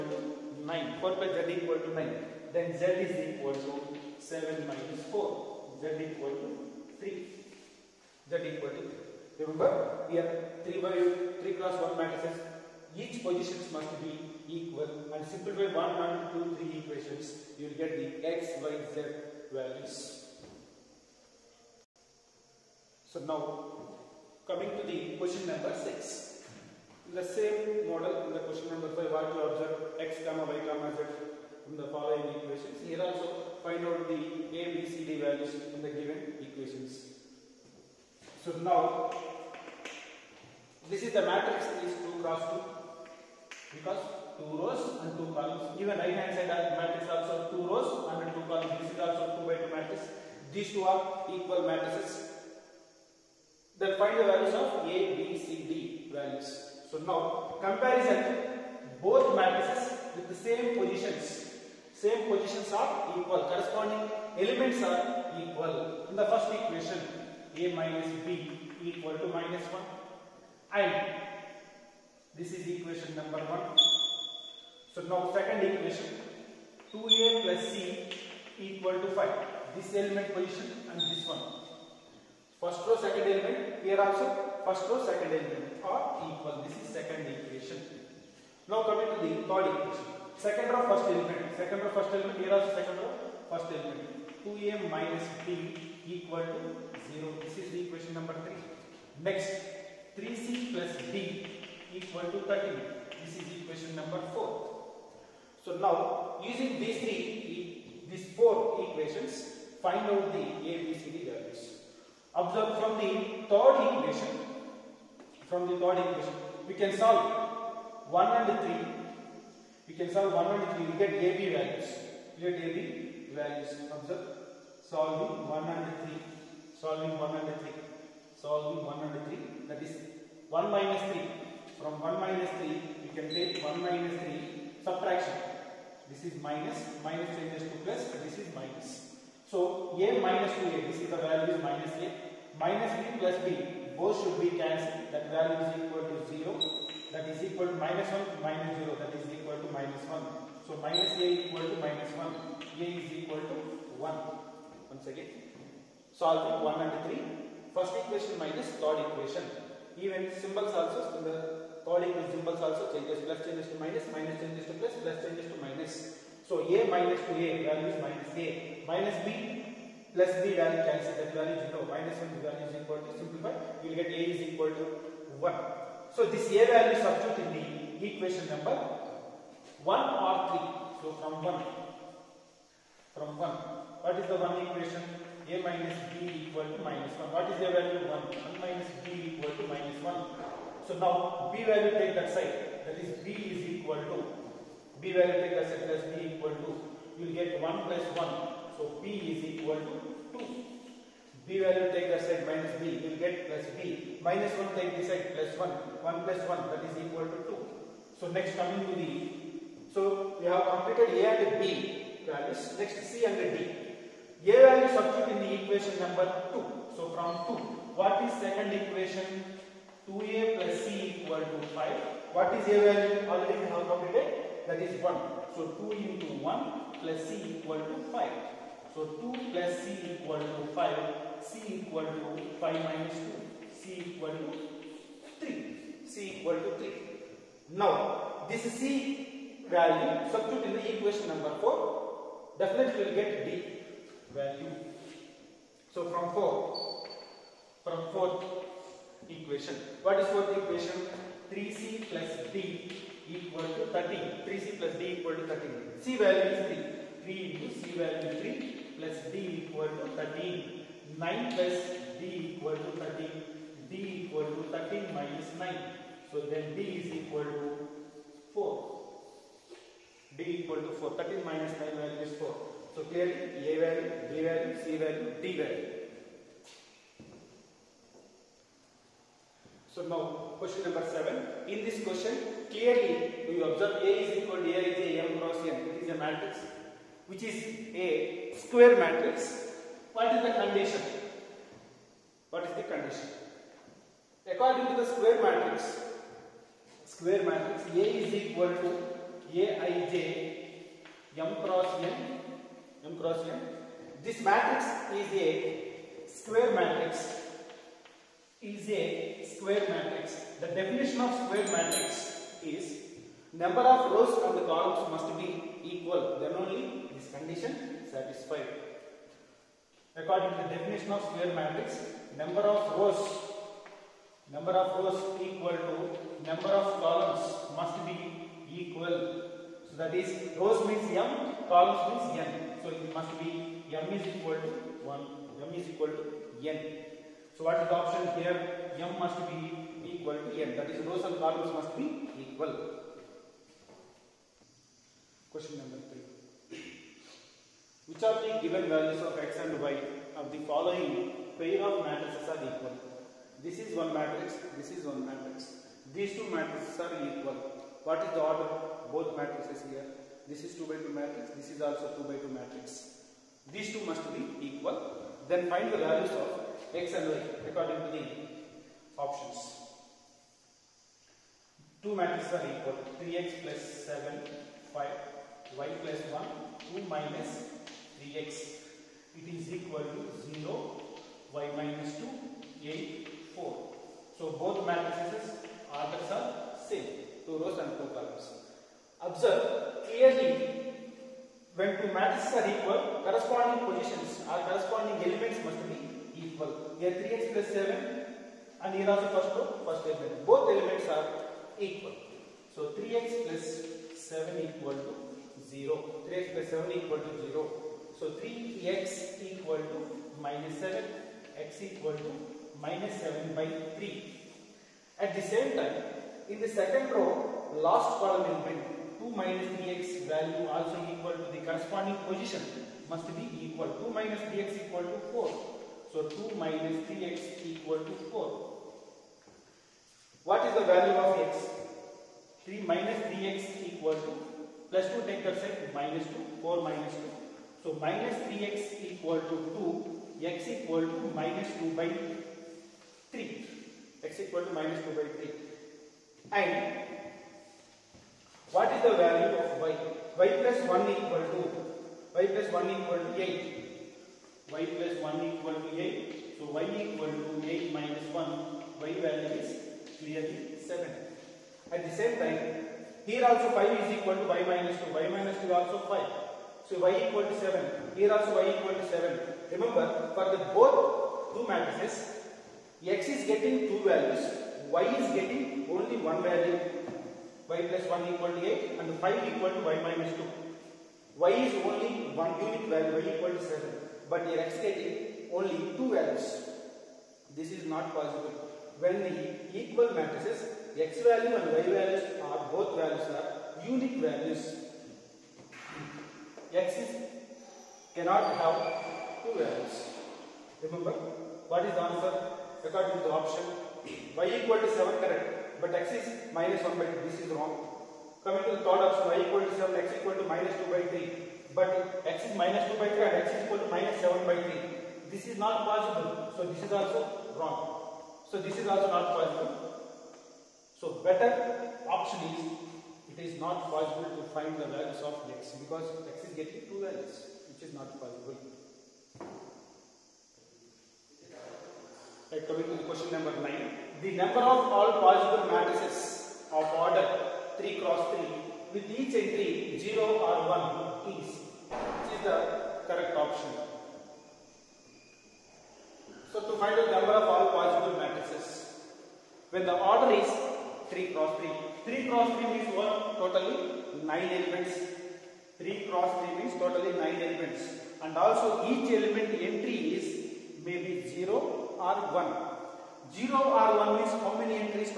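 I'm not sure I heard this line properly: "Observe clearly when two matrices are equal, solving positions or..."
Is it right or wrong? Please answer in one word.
wrong.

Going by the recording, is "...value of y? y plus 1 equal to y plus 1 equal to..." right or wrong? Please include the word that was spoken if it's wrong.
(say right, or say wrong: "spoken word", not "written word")
right.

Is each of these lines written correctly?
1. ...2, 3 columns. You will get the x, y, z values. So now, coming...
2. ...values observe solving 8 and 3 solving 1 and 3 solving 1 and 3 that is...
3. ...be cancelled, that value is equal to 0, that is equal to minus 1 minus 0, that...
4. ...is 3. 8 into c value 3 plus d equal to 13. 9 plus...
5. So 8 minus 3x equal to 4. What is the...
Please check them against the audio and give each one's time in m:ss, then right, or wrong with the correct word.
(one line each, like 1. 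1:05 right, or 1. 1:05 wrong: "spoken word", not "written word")
1. 0:16 wrong: "equations", not "columns"
2. 2:03 wrong: "1", not "8"
3. 2:24 right
4. 4:16 wrong: "3", not "8"
5. 7:06 wrong: "2", not "8".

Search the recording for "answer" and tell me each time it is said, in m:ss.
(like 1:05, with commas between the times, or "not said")
8:22.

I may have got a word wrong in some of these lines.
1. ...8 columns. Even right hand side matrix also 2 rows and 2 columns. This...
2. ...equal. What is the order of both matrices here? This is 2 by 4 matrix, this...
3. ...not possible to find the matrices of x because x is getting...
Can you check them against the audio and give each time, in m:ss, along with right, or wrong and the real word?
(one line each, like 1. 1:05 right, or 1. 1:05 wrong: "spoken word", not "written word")
1. 0:45 wrong: "2", not "8"
2. 5:57 wrong: "2", not "4"
3. 8:43 wrong: "values", not "matrices".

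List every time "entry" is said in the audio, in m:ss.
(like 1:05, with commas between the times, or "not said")
8:59, 9:19.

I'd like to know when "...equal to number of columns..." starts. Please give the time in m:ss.
5:25.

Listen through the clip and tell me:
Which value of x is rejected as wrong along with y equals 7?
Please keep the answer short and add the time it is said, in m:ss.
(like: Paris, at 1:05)
-1/2, at 8:26.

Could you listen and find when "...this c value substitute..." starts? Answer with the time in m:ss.
3:58.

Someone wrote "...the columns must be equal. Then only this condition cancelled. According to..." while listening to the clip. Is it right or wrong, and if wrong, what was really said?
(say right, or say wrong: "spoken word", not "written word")
wrong: "satisfied", not "cancelled".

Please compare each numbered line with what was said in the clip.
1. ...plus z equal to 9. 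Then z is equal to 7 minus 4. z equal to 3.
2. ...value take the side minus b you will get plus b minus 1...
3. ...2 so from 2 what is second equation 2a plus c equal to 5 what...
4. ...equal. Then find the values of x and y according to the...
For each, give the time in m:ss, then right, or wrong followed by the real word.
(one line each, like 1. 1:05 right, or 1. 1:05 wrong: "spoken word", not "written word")
1. 0:01 right
2. 3:21 right
3. 3:36 right
4. 6:04 right.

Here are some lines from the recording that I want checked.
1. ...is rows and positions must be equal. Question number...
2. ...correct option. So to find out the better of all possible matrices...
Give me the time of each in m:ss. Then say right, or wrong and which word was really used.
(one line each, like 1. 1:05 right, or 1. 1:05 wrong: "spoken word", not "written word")
1. 5:40 wrong: "columns", not "positions"
2. 9:03 wrong: "number", not "better".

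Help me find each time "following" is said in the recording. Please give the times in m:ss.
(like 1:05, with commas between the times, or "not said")
0:31, 5:50.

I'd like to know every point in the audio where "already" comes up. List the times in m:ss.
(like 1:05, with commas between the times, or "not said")
3:43.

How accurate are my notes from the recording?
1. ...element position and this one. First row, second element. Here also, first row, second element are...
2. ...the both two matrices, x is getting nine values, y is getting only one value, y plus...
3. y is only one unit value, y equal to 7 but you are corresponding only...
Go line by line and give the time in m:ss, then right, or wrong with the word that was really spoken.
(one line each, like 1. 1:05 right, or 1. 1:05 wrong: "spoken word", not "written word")
1. 1:19 right
2. 7:50 wrong: "two", not "nine"
3. 8:01 wrong: "exciting", not "corresponding".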